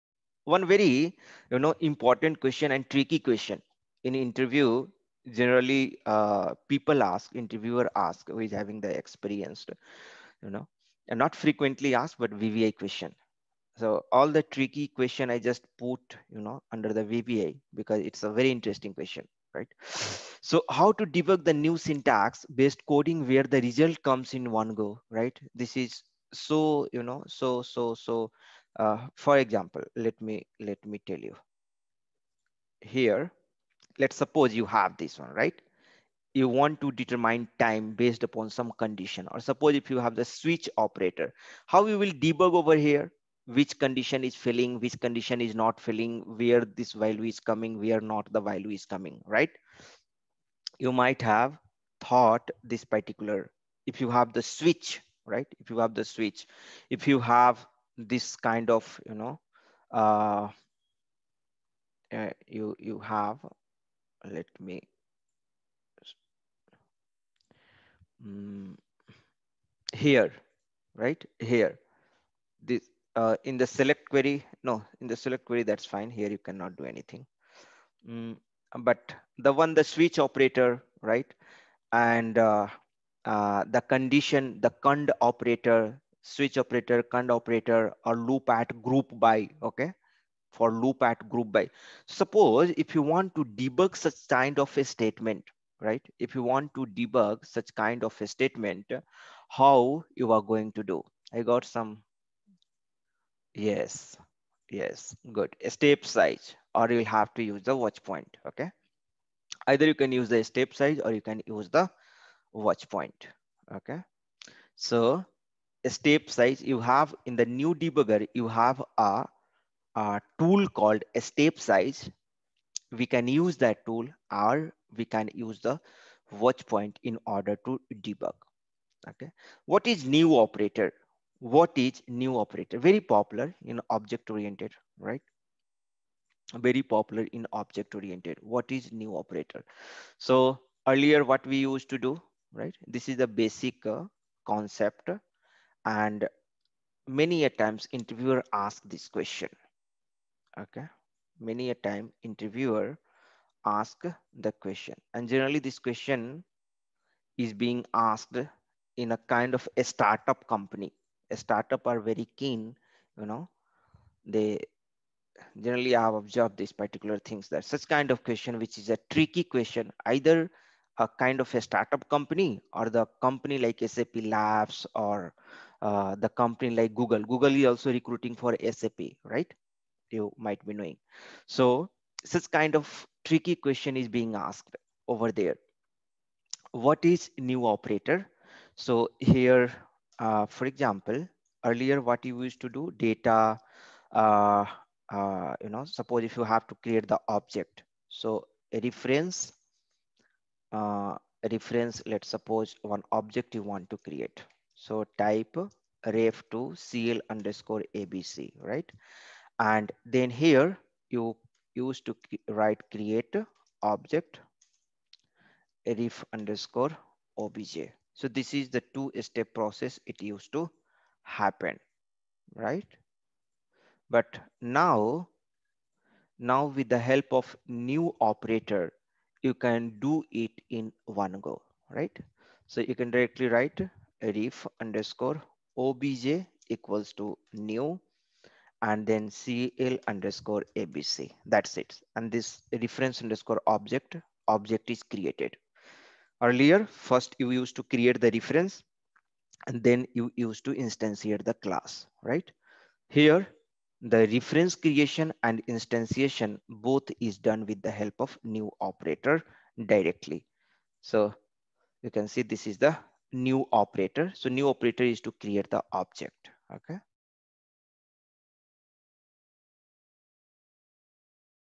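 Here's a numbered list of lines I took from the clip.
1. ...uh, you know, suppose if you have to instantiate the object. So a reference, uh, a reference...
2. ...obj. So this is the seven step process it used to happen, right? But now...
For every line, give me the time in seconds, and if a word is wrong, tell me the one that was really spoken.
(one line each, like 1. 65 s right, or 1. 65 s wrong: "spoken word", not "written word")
1. 195 s wrong: "create", not "instantiate"
2. 217 s wrong: "two", not "seven".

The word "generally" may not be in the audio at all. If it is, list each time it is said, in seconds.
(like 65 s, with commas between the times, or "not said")
5 s, 155 s, 165 s.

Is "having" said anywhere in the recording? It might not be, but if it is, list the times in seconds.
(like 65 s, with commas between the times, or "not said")
8 s.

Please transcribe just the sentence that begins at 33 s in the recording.
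Let's suppose you have this one, right?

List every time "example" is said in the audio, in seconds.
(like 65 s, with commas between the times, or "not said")
29 s, 190 s.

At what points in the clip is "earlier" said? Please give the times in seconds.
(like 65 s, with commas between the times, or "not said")
140 s, 191 s, 246 s.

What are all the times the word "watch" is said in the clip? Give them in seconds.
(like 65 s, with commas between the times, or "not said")
107 s, 112 s, 126 s.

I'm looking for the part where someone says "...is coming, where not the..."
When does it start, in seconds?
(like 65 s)
47 s.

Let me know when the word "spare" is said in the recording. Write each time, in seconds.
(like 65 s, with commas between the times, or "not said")
not said.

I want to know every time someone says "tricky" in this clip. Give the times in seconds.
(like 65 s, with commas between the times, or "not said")
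2 s, 14 s, 169 s, 183 s.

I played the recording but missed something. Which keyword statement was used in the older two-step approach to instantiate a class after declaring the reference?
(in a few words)
CREATE OBJECT.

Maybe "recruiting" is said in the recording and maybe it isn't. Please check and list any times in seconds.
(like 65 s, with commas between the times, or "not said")
177 s.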